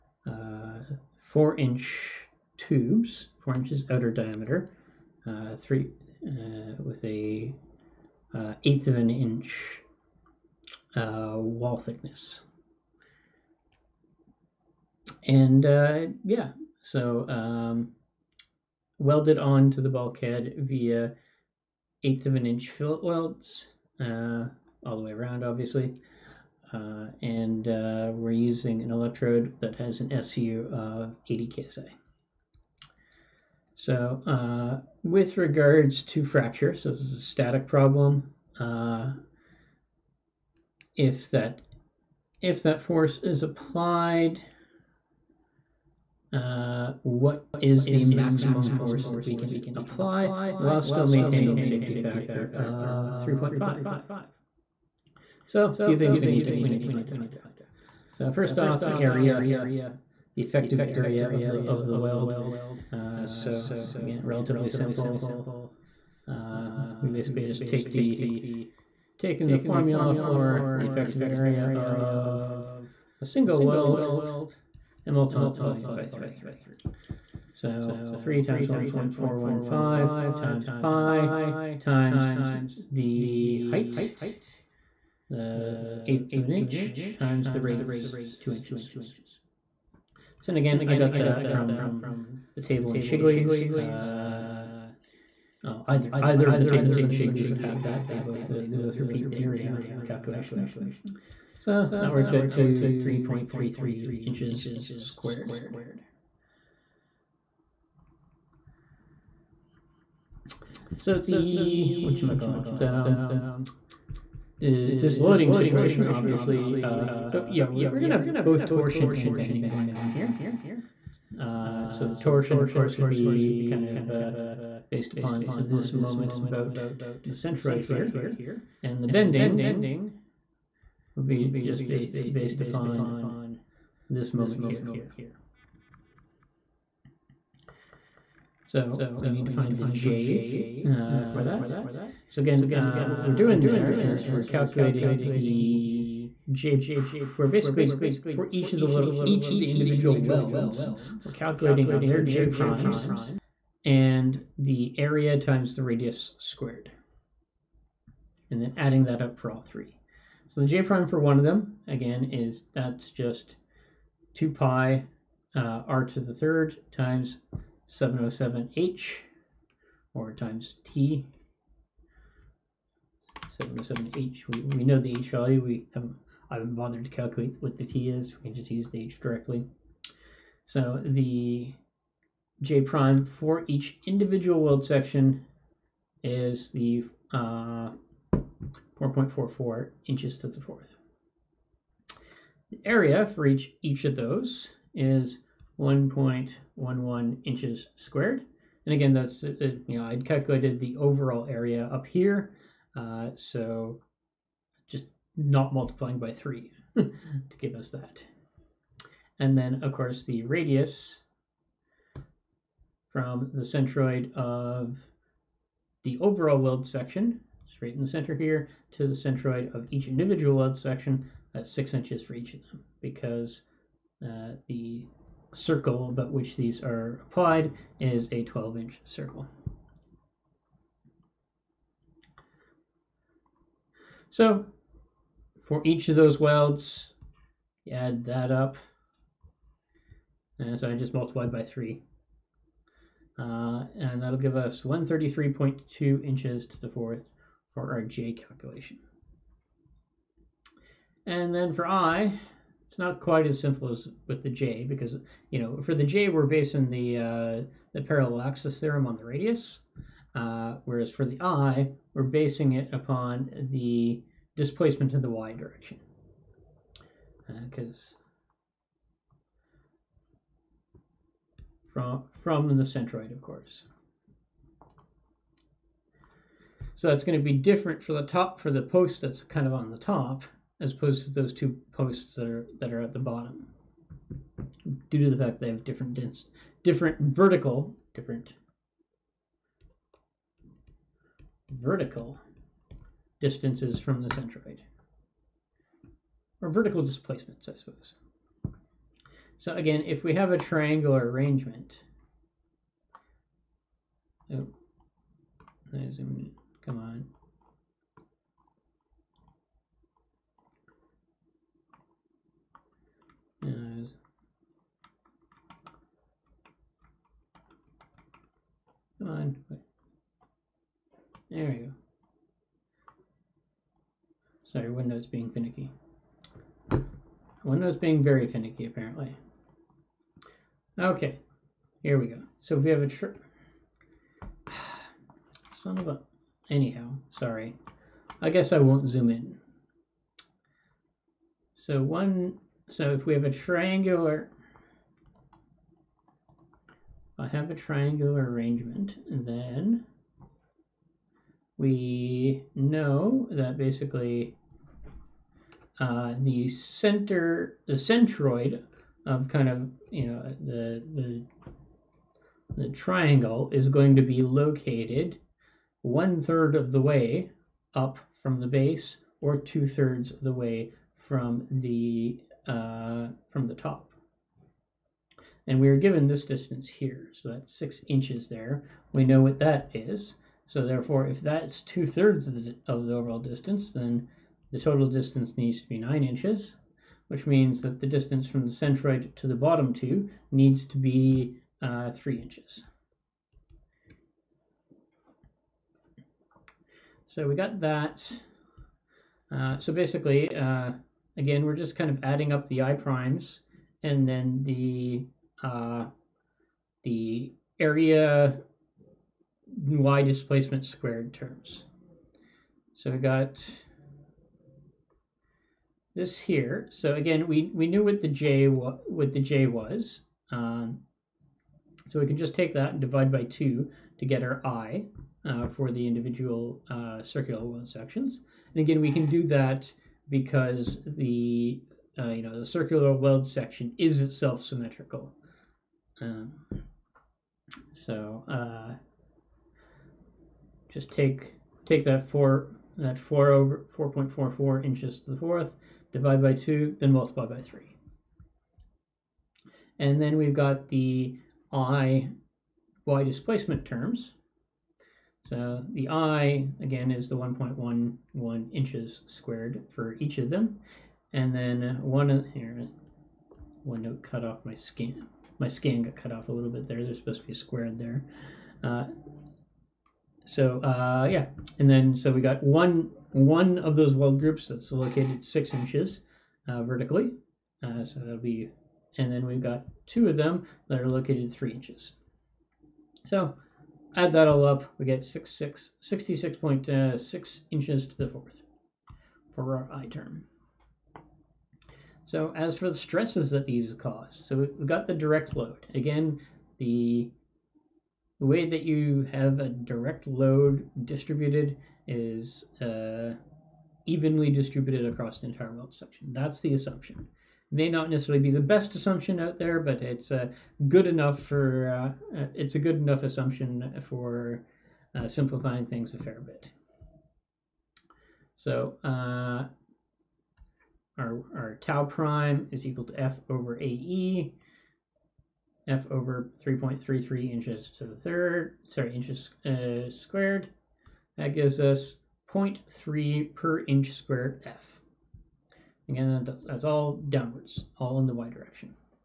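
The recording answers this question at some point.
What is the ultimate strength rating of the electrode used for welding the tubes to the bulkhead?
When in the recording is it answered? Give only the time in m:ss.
0:31.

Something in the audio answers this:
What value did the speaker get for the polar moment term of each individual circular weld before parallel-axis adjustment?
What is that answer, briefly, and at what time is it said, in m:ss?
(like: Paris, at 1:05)
4.44 inches^4, at 3:08.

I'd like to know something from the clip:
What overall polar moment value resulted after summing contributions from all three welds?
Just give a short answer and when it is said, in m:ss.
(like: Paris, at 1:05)
133.2 inches^4, at 4:04.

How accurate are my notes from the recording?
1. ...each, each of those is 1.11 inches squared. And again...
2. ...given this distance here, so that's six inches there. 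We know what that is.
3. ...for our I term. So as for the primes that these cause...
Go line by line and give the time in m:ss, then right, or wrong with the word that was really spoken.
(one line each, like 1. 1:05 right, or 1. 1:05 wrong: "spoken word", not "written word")
1. 3:13 right
2. 6:15 right
3. 8:09 wrong: "stresses", not "primes".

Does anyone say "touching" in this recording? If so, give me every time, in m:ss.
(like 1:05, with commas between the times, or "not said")
not said.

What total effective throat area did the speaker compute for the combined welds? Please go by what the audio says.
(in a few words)
3.33 square inches.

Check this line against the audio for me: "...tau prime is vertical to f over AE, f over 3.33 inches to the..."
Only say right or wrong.
wrong.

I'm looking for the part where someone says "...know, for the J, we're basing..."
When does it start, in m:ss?
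4:15.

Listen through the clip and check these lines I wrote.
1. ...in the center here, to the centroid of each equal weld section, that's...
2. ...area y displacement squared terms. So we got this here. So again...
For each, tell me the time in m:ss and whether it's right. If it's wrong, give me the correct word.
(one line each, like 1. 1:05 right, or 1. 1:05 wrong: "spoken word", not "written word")
1. 3:37 wrong: "individual", not "equal"
2. 6:47 right.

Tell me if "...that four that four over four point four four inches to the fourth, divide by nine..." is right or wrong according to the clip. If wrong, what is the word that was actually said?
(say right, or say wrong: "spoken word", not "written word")
wrong: "two", not "nine".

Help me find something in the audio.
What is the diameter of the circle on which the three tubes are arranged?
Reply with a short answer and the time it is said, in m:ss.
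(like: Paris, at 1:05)
12 inches, at 3:48.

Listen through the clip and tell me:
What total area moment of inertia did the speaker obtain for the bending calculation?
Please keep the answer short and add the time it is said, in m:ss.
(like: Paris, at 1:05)
66.66 inches^4, at 8:05.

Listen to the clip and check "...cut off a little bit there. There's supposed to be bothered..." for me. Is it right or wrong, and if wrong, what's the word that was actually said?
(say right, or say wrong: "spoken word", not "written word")
wrong: "squared", not "bothered".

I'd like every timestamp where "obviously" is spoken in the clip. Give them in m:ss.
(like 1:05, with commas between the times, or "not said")
0:25, 1:56.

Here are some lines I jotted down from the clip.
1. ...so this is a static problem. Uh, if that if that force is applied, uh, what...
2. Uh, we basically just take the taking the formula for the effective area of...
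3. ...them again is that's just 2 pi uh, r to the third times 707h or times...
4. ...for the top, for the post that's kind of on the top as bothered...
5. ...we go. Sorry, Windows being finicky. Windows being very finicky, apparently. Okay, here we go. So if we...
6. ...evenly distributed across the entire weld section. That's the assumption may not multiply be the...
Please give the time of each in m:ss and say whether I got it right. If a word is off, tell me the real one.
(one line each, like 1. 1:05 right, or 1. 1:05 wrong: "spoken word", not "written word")
1. 0:36 right
2. 1:06 right
3. 2:41 right
4. 4:38 wrong: "opposed", not "bothered"
5. 5:21 right
6. 8:24 wrong: "necessarily", not "multiply".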